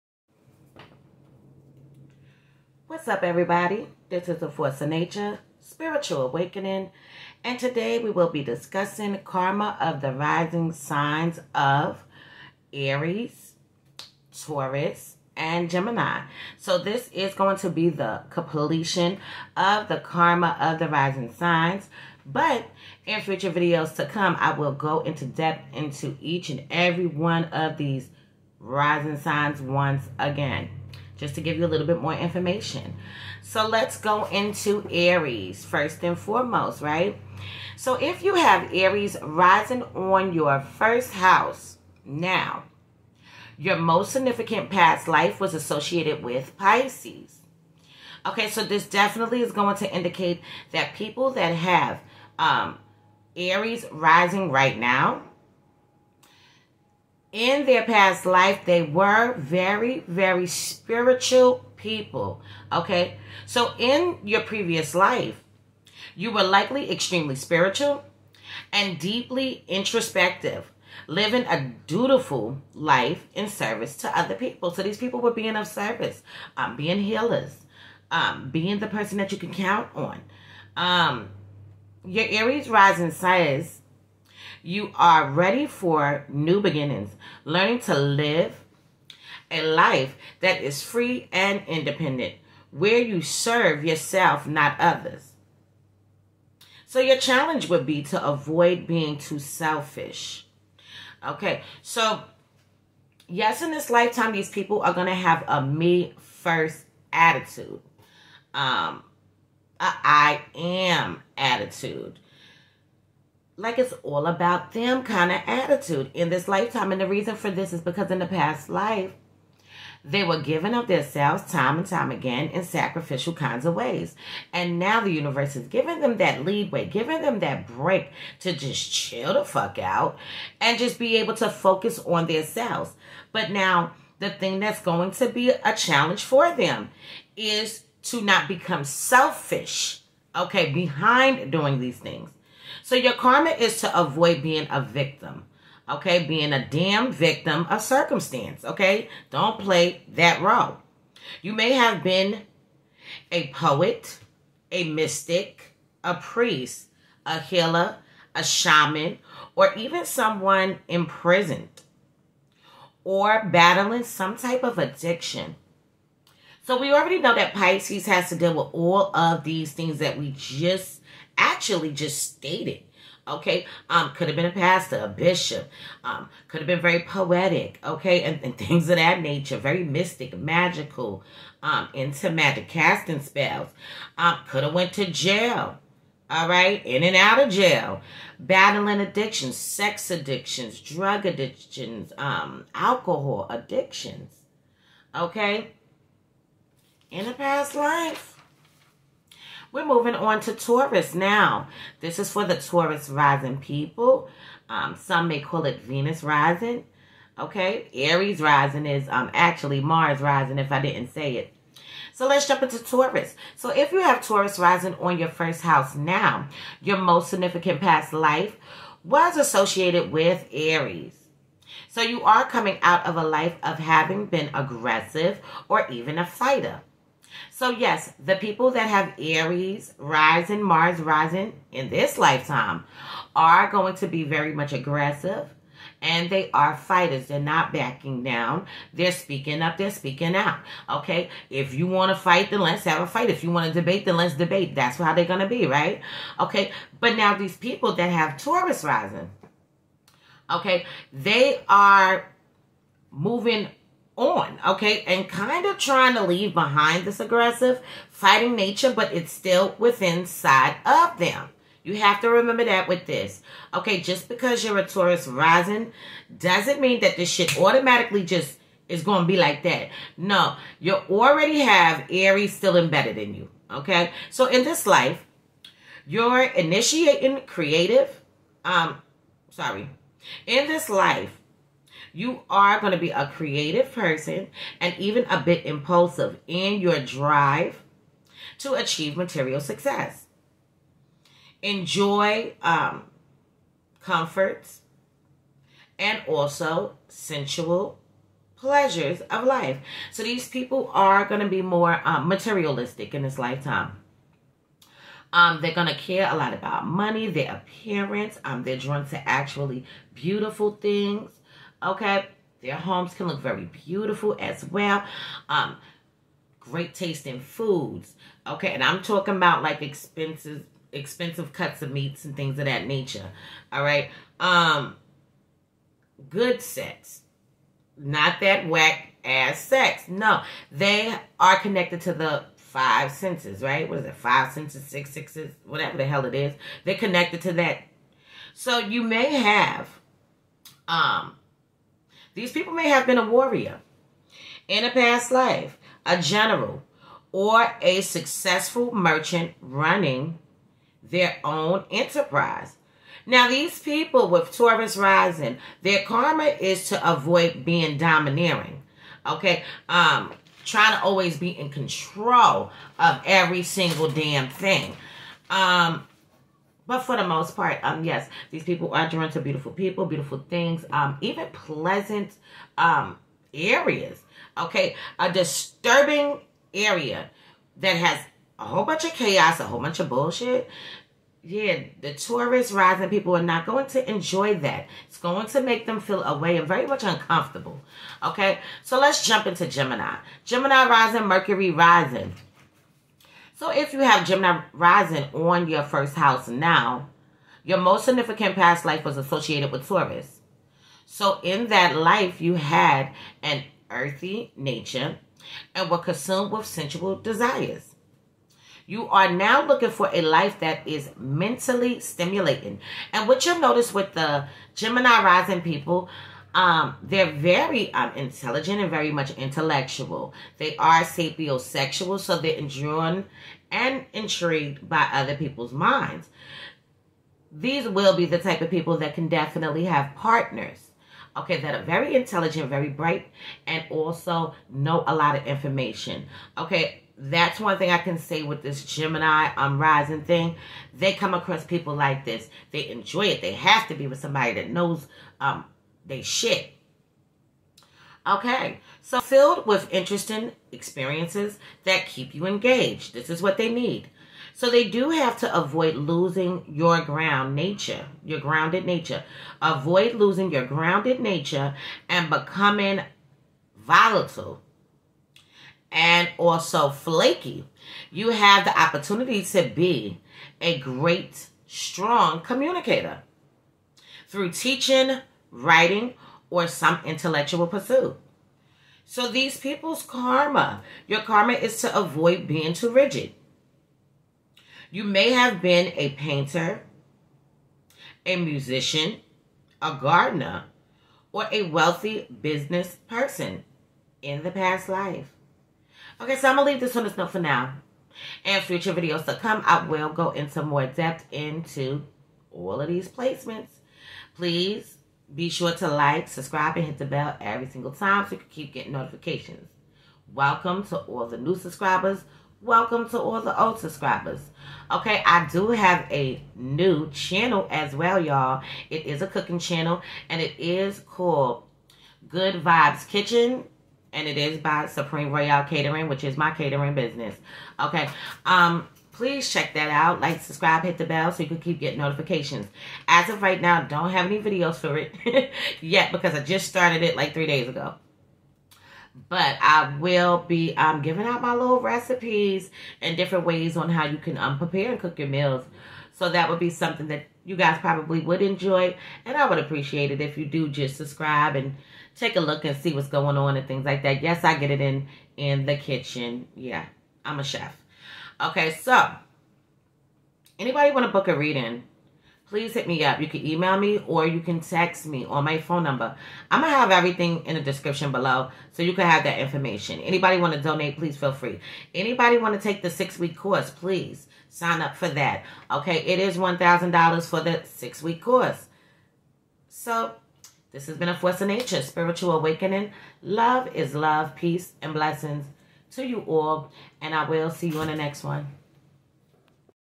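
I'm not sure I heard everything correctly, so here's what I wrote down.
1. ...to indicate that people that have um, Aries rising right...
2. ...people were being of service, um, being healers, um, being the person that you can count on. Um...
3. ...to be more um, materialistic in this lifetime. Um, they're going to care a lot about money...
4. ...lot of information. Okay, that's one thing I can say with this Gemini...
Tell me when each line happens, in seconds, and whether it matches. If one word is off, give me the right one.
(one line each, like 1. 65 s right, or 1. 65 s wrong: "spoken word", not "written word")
1. 49 s right
2. 74 s right
3. 301 s right
4. 435 s right.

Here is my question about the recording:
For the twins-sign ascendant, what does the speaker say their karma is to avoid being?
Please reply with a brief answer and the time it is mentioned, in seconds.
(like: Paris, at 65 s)
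too rigid, at 482 s.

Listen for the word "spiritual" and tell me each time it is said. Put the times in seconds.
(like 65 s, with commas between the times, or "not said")
5 s, 60 s, 67 s, 581 s.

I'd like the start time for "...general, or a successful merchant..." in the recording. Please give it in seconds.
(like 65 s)
346 s.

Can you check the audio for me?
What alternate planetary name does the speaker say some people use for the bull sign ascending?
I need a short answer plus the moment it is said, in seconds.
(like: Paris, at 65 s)
Venus rising, at 205 s.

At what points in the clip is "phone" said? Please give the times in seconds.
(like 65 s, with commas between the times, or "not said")
565 s.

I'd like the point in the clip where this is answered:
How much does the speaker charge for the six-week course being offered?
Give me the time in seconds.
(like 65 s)
576 s.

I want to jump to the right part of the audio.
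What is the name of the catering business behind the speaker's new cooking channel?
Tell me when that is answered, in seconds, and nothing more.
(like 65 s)
524 s.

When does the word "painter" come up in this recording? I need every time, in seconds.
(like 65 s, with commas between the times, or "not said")
486 s.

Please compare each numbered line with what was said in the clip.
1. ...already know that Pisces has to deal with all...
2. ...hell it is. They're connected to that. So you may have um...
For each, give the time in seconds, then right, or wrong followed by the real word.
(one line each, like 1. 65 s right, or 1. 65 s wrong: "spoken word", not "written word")
1. 166 s right
2. 336 s right.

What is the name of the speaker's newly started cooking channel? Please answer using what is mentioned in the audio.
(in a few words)
Good Vibes Kitchen.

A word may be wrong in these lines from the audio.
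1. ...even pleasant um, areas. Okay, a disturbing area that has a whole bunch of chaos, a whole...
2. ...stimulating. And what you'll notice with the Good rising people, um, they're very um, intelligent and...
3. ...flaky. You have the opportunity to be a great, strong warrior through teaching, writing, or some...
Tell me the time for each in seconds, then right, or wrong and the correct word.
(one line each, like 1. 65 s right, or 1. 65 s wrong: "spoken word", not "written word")
1. 371 s right
2. 411 s wrong: "Gemini", not "Good"
3. 466 s wrong: "communicator", not "warrior".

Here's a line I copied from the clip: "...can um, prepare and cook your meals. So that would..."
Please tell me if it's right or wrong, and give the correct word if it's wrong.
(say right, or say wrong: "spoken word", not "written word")
right.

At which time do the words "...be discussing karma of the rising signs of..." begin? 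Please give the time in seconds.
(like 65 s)
8 s.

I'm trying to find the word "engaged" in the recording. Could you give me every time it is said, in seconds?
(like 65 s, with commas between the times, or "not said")
452 s.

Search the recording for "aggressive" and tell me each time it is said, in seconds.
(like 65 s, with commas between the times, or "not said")
224 s, 234 s, 257 s.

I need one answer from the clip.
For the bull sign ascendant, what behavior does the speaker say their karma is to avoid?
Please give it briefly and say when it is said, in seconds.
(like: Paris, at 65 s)
being domineering, at 357 s.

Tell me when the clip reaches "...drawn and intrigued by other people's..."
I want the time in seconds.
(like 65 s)
422 s.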